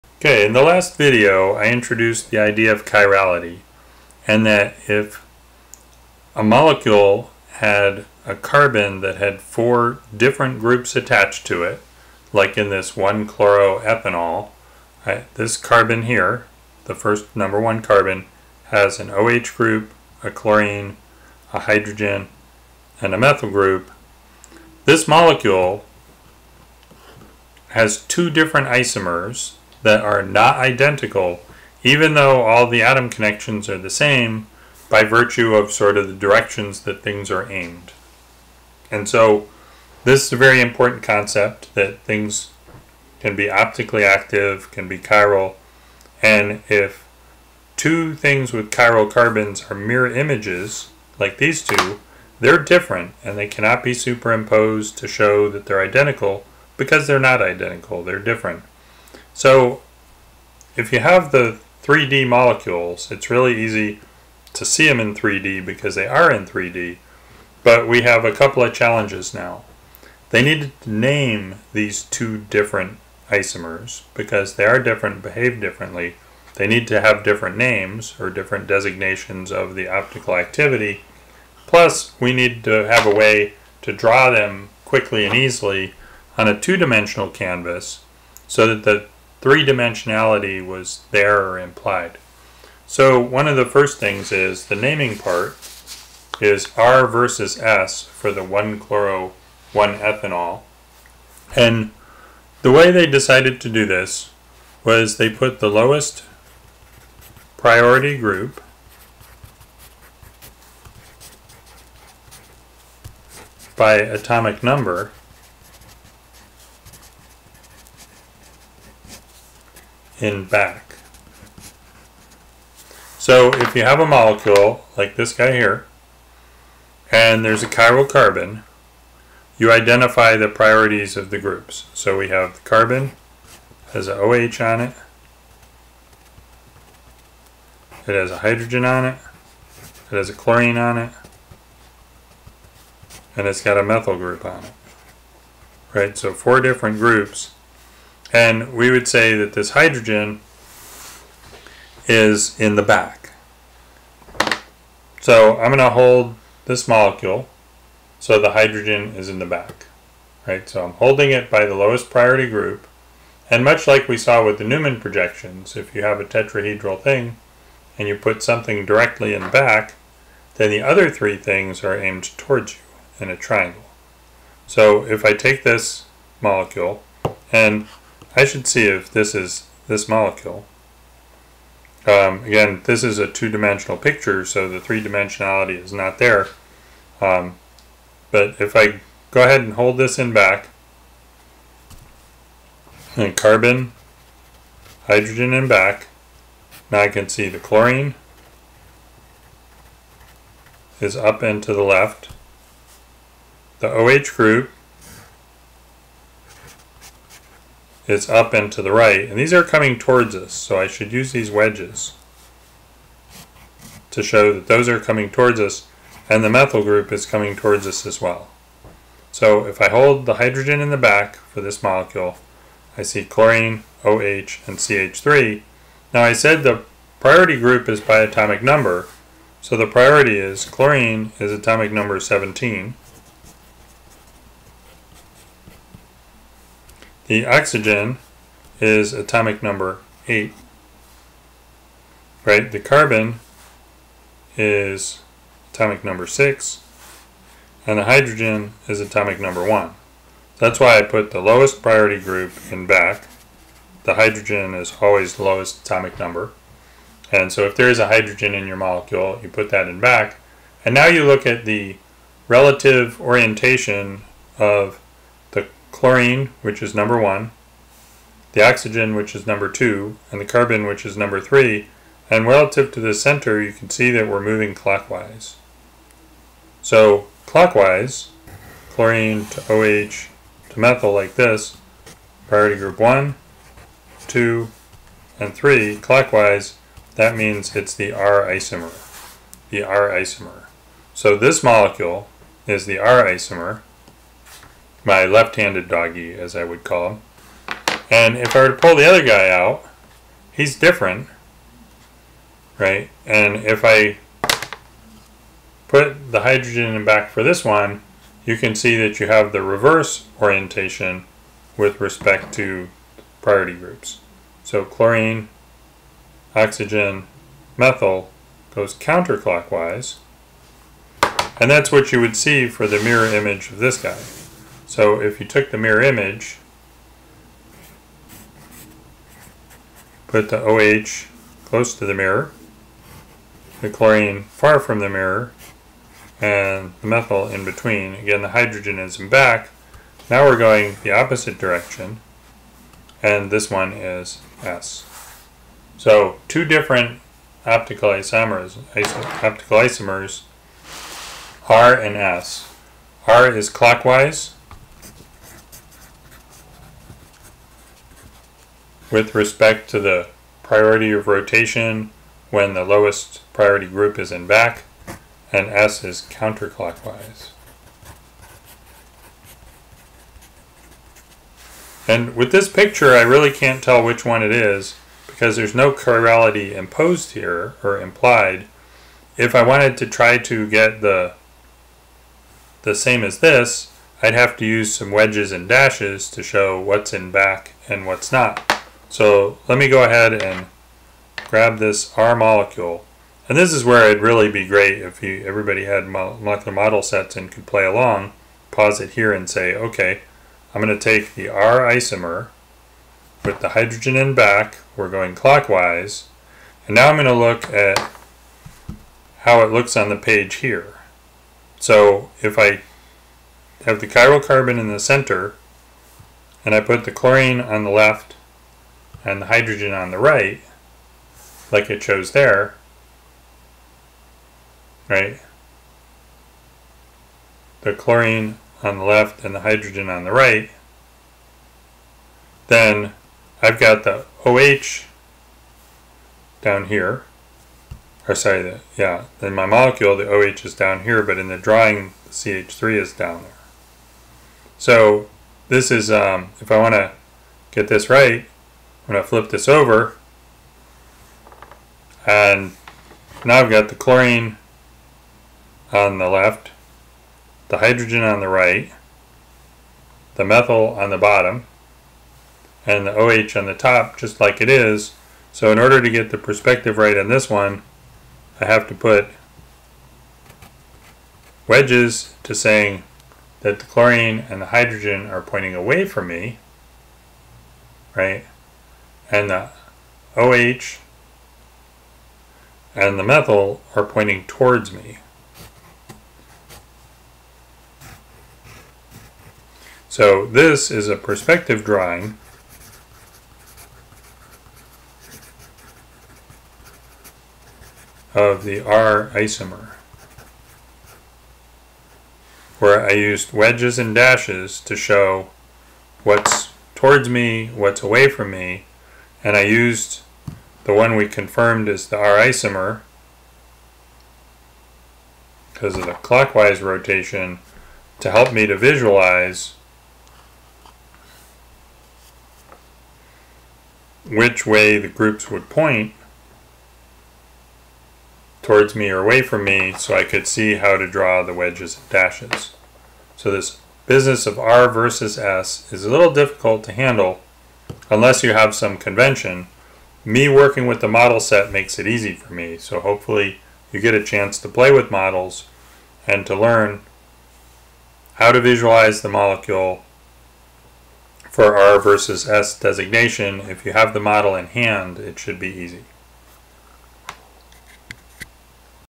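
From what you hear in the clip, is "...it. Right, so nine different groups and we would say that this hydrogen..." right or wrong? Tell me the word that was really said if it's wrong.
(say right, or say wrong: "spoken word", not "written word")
wrong: "four", not "nine".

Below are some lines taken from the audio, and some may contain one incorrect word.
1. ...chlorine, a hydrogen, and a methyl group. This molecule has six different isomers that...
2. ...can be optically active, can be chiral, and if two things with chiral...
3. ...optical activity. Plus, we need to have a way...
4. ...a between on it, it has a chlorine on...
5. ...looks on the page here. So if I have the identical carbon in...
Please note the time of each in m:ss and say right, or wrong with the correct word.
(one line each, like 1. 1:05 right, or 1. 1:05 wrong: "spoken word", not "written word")
1. 0:20 wrong: "two", not "six"
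2. 0:43 right
3. 1:19 right
4. 2:18 wrong: "hydrogen", not "between"
5. 6:49 wrong: "chiral", not "identical".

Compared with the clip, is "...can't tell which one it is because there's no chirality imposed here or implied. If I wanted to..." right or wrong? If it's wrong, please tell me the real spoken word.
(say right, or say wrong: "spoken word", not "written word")
right.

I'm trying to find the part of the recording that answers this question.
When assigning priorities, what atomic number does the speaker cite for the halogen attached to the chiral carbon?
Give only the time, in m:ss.
3:52.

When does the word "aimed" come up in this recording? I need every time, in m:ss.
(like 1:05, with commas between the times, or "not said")
0:37, 2:51.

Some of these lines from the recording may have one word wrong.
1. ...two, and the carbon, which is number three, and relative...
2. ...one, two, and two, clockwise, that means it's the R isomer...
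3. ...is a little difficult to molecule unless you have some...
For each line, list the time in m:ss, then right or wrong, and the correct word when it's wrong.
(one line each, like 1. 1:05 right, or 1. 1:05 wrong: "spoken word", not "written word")
1. 4:29 right
2. 4:42 wrong: "three", not "two"
3. 8:55 wrong: "handle", not "molecule".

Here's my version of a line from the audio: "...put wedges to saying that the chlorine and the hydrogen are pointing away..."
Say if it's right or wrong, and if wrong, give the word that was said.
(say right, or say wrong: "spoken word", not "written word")
right.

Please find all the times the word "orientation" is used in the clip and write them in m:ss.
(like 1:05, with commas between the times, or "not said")
4:23, 5:10.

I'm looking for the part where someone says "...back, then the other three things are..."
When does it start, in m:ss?
2:49.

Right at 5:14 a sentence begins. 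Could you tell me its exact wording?
So chlorine, oxygen, methyl goes counterclockwise, and that's what you would see for the mirror image of this guy.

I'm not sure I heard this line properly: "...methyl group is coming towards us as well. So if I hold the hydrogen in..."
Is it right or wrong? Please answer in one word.
right.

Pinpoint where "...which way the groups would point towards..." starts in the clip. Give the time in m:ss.
8:44.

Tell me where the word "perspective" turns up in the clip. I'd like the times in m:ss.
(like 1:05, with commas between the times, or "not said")
7:46, 8:11.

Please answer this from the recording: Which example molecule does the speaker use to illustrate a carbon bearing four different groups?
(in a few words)
1-chloroethanol.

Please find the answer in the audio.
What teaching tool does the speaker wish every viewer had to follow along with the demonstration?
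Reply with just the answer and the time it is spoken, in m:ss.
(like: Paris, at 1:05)
molecular model sets, at 6:36.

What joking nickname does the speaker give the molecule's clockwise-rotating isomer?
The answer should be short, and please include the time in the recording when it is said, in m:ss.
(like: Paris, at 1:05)
left-handed doggy, at 4:55.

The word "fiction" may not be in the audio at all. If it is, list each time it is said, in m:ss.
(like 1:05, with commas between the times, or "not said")
not said.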